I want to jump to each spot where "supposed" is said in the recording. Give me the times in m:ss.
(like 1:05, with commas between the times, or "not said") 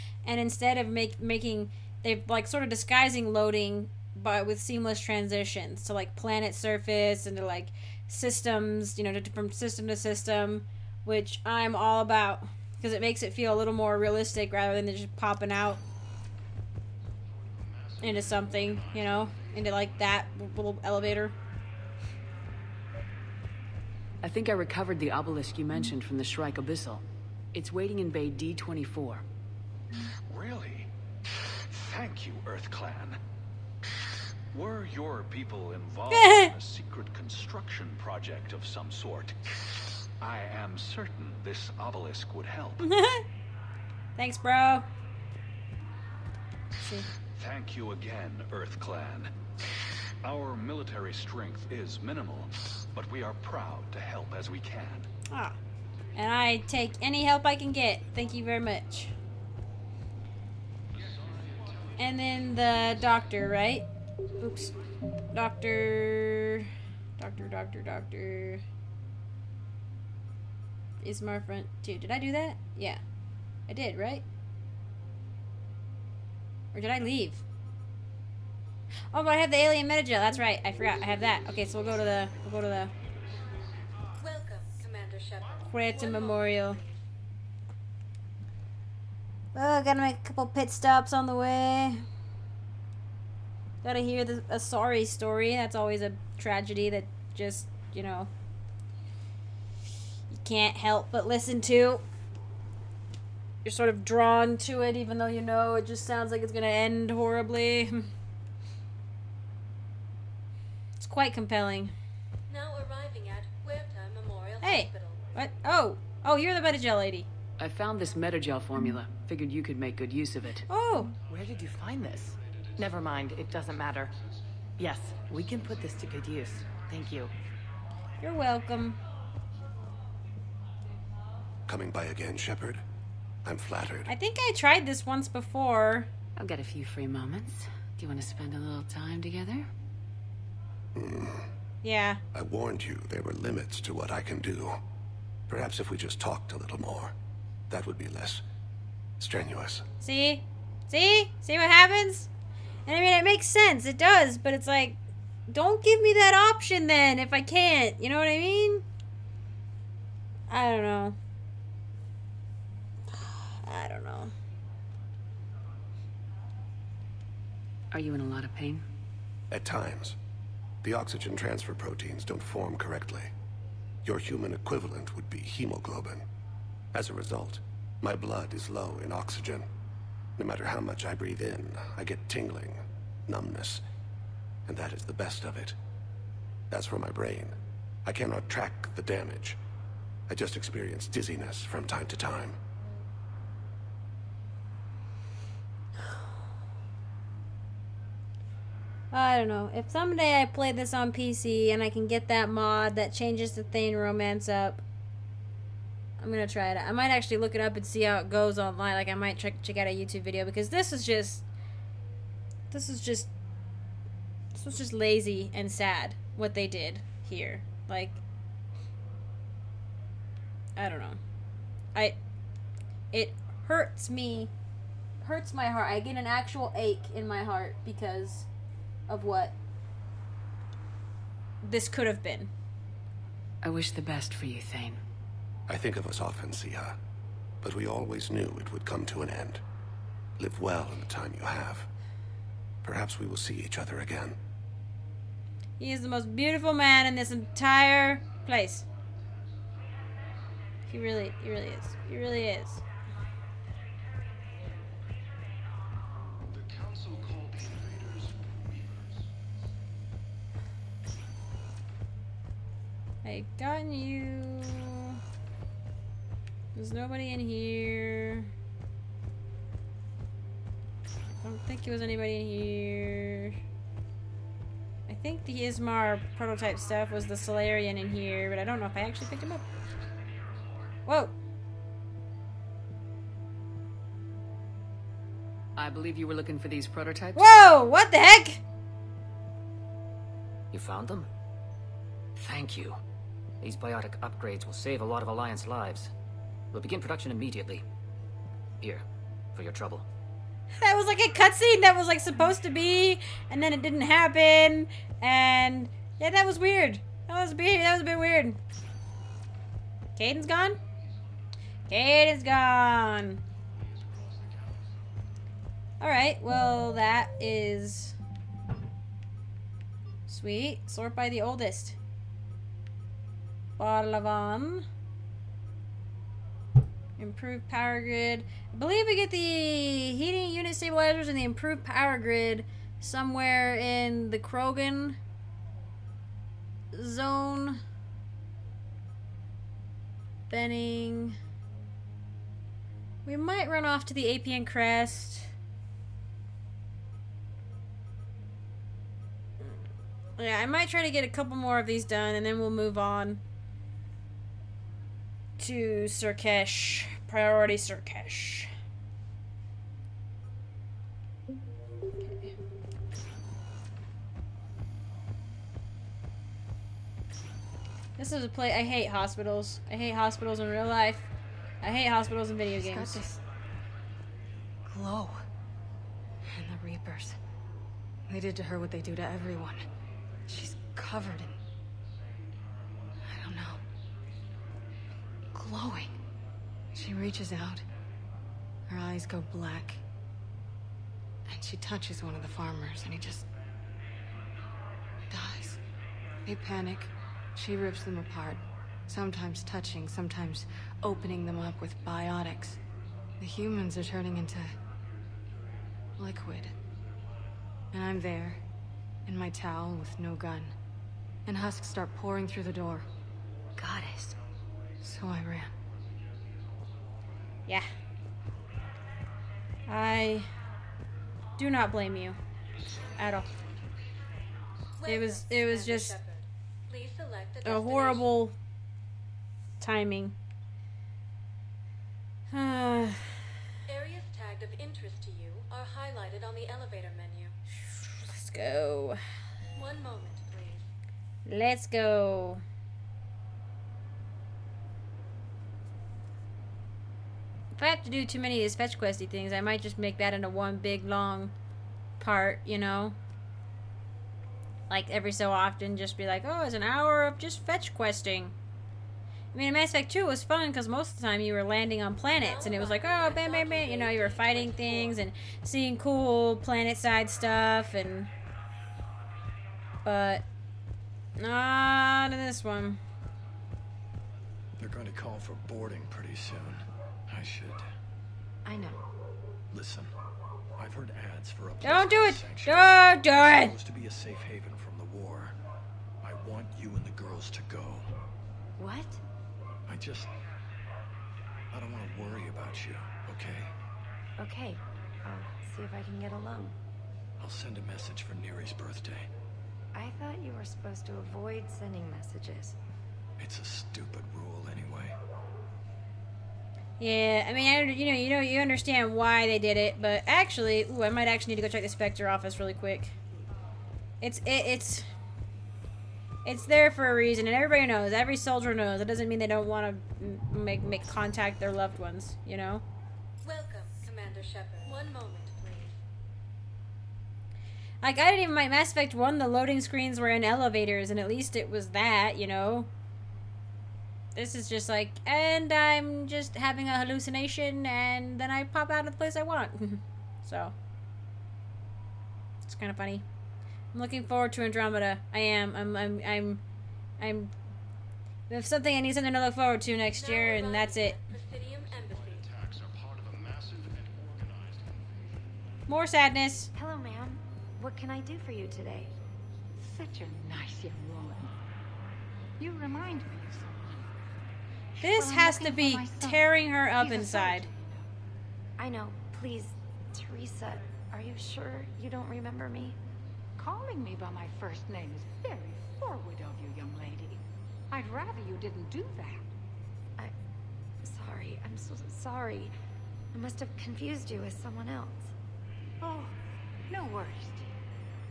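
5:02, 8:03, 8:20.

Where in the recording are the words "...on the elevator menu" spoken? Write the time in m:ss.
7:16.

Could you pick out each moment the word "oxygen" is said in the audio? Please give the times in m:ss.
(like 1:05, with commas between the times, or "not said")
2:50, 2:59.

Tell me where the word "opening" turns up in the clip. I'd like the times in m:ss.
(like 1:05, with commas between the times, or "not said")
6:41.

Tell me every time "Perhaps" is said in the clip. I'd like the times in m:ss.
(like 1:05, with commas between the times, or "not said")
2:25, 4:02.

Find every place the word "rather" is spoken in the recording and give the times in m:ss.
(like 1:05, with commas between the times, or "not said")
0:14, 9:38.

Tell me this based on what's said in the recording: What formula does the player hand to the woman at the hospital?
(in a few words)
alien metagel.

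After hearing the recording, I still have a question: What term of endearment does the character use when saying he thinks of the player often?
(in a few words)
siha.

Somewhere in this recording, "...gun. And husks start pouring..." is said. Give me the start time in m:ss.
6:50.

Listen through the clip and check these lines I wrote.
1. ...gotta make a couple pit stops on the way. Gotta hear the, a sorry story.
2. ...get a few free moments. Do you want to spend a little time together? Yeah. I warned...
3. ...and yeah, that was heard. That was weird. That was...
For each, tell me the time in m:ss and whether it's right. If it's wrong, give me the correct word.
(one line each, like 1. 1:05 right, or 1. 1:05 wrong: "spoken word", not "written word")
1. 1:29 right
2. 2:16 right
3. 5:05 wrong: "weird", not "heard".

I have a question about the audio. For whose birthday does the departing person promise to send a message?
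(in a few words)
Neri.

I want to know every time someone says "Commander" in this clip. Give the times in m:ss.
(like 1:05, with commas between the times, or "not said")
1:24, 8:44.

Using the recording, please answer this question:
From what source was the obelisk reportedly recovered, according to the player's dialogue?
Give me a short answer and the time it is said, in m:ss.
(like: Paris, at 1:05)
Shrike Abyssal, at 0:26.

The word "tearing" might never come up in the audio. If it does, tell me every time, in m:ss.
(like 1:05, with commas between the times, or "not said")
9:26.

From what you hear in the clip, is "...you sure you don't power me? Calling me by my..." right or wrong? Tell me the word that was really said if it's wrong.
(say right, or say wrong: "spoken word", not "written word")
wrong: "remember", not "power".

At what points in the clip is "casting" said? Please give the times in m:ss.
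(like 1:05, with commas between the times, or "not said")
not said.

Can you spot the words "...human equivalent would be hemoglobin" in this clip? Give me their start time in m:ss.
2:54.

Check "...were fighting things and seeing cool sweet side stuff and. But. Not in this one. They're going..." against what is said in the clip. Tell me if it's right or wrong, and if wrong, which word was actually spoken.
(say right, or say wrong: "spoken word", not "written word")
wrong: "planet", not "sweet".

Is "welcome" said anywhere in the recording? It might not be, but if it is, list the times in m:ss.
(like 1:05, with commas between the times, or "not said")
1:24, 2:08, 8:43.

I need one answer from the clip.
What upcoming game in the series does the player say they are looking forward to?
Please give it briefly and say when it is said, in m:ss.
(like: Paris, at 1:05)
Andromeda, at 9:04.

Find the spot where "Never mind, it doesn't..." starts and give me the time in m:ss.
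2:02.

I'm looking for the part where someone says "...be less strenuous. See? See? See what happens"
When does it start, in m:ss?
2:27.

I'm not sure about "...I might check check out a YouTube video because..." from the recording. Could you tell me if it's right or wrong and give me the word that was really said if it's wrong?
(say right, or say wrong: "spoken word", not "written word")
right.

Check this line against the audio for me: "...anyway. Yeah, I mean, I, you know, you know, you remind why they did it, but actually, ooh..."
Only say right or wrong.
wrong.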